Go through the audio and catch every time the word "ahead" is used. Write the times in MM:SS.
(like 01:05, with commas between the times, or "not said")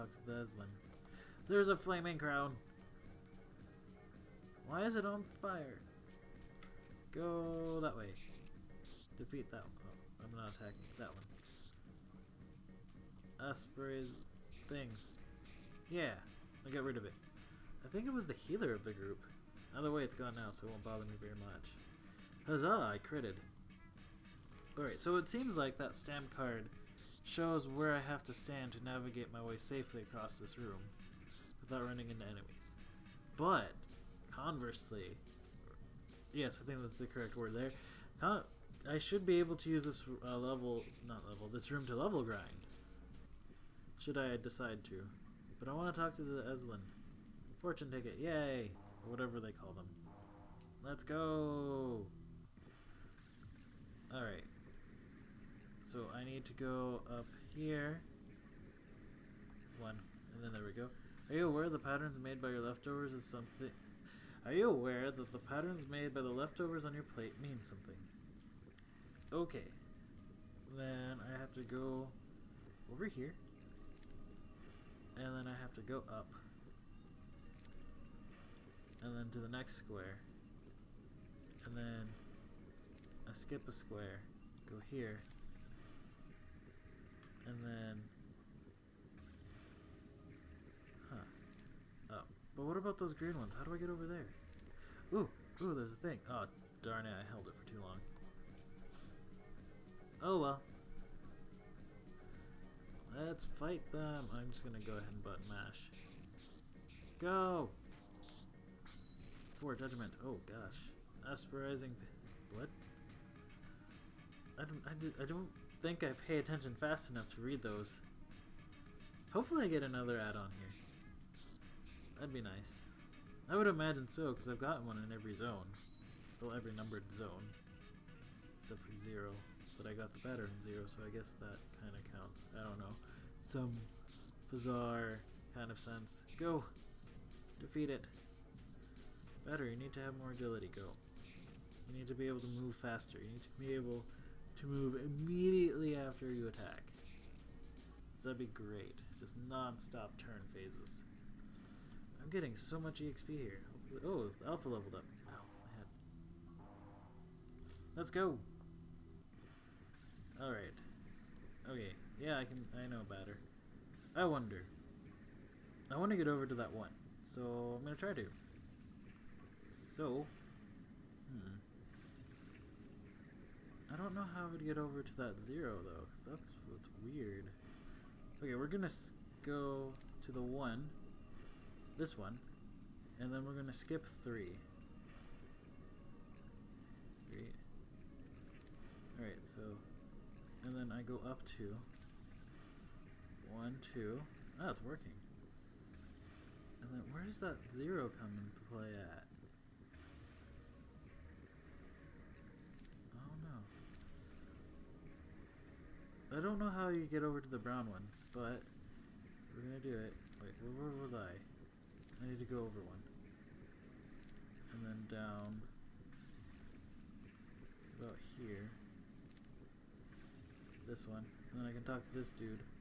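01:44.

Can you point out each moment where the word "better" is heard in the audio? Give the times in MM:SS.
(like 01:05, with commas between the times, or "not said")
02:10, 02:19.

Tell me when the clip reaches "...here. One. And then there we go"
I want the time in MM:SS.
00:57.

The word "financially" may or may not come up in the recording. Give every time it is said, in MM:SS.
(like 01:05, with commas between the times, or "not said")
not said.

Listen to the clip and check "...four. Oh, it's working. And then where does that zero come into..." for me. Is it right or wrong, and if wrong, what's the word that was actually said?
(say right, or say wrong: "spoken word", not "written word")
wrong: "two", not "four".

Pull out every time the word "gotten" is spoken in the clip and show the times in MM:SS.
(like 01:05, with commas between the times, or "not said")
02:04.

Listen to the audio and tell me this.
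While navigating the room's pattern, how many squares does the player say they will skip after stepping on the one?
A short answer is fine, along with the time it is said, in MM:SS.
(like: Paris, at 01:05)
3, at 03:04.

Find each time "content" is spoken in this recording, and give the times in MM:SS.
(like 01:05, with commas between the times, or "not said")
not said.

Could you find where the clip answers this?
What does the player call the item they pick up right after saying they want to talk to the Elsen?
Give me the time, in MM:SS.
00:47.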